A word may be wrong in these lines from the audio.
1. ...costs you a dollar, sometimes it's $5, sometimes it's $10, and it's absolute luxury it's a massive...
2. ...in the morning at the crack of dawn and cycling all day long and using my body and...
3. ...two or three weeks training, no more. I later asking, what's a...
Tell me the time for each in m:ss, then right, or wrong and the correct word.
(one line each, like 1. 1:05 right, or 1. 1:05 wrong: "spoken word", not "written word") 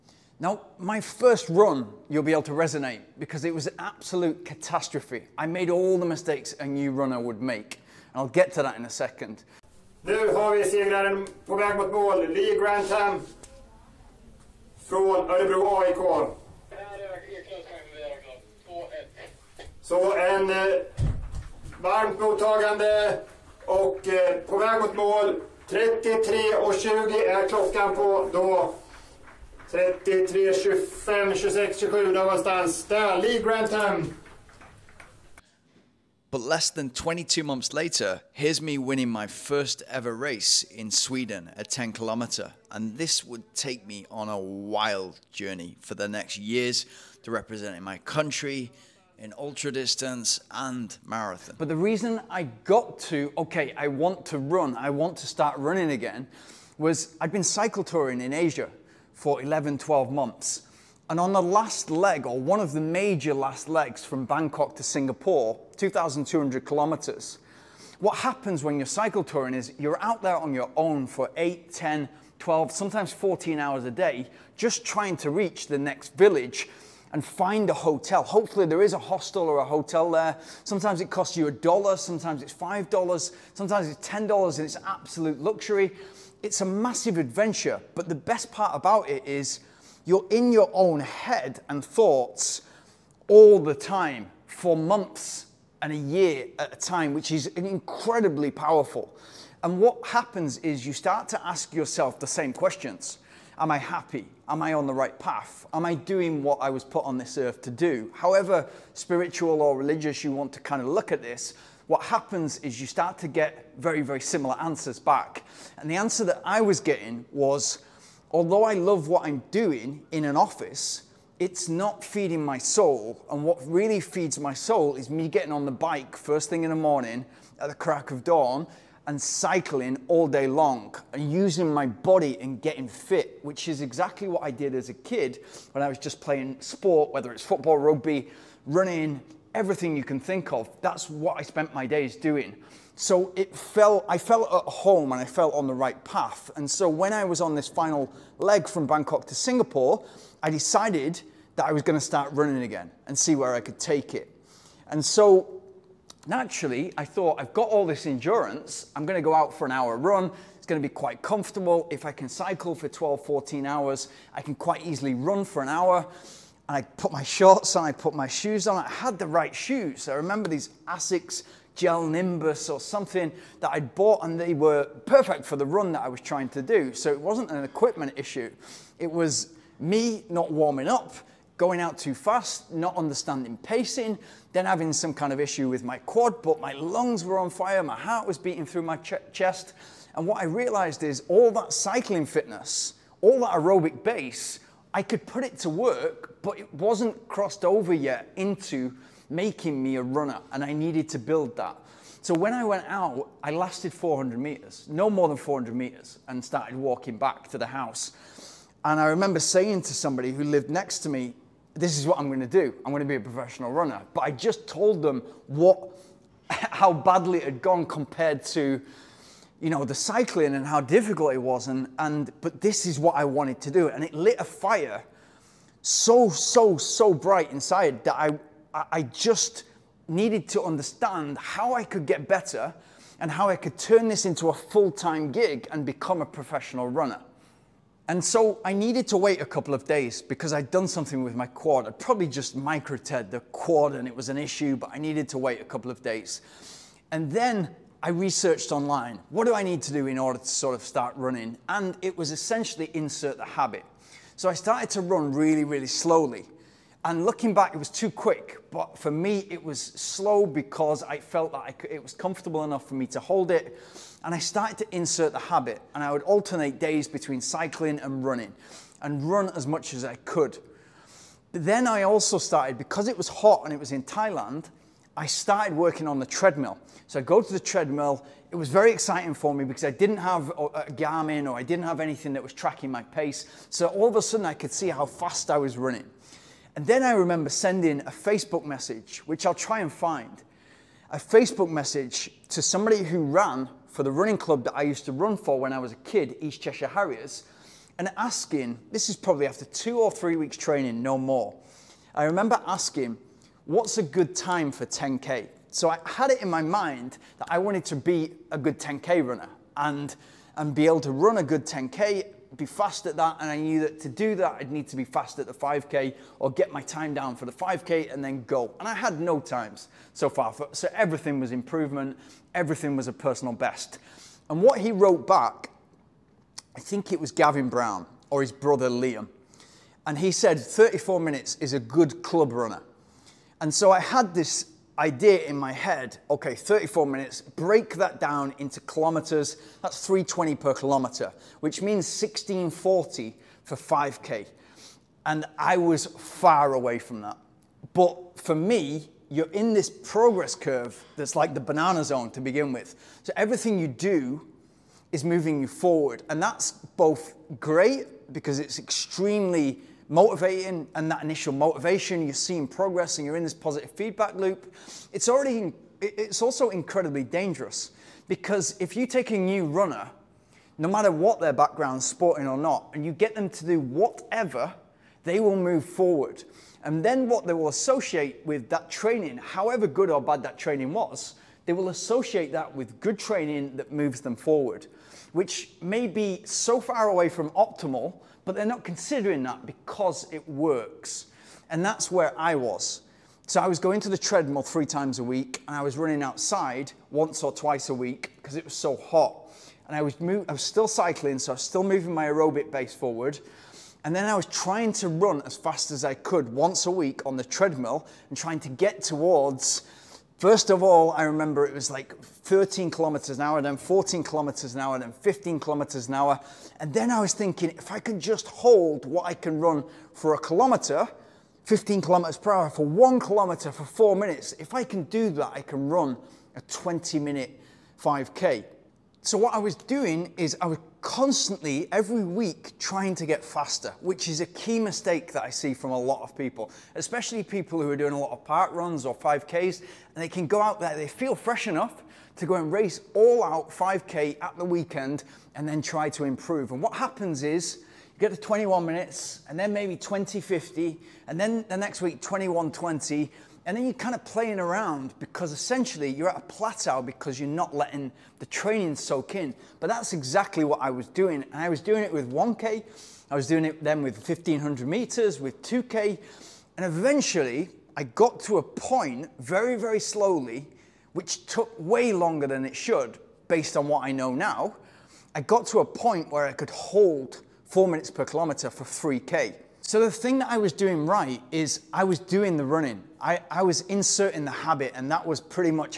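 1. 1:21 right
2. 2:06 right
3. 4:59 wrong: "remember", not "later".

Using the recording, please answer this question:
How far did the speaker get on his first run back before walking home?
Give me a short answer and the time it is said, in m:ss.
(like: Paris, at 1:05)
400 meters, at 3:24.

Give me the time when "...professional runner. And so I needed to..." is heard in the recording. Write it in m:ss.
3:56.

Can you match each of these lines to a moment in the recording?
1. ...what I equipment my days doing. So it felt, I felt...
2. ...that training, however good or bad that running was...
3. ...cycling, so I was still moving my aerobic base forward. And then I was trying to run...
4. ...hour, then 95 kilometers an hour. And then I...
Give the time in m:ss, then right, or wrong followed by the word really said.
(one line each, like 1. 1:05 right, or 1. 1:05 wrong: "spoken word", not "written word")
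1. 2:21 wrong: "spent", not "equipment"
2. 6:18 wrong: "training", not "running"
3. 6:40 right
4. 6:54 wrong: "15", not "95".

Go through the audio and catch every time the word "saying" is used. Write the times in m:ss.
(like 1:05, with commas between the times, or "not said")
3:29.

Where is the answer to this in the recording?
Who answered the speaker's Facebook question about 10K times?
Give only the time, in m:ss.
5:27.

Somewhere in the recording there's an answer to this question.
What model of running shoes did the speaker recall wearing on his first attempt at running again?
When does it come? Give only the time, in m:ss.
2:50.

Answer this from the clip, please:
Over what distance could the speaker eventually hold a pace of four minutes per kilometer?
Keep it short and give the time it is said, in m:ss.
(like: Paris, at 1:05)
3K, at 7:58.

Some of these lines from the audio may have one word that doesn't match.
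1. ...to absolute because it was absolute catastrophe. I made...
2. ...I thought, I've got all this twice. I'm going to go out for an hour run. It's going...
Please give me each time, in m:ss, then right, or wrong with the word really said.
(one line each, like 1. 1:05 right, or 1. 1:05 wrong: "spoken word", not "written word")
1. 0:02 wrong: "resonate", not "absolute"
2. 2:36 wrong: "endurance", not "twice".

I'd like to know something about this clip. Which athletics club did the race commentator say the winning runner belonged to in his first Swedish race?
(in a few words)
Örebro AIK.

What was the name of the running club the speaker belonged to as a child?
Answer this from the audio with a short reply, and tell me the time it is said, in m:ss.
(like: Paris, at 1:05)
East Cheshire Harriers, at 4:56.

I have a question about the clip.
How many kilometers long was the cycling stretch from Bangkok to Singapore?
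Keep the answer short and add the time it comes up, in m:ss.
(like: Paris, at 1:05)
2,200 kilometers, at 1:05.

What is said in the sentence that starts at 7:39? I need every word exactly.
But that's exactly what I was doing.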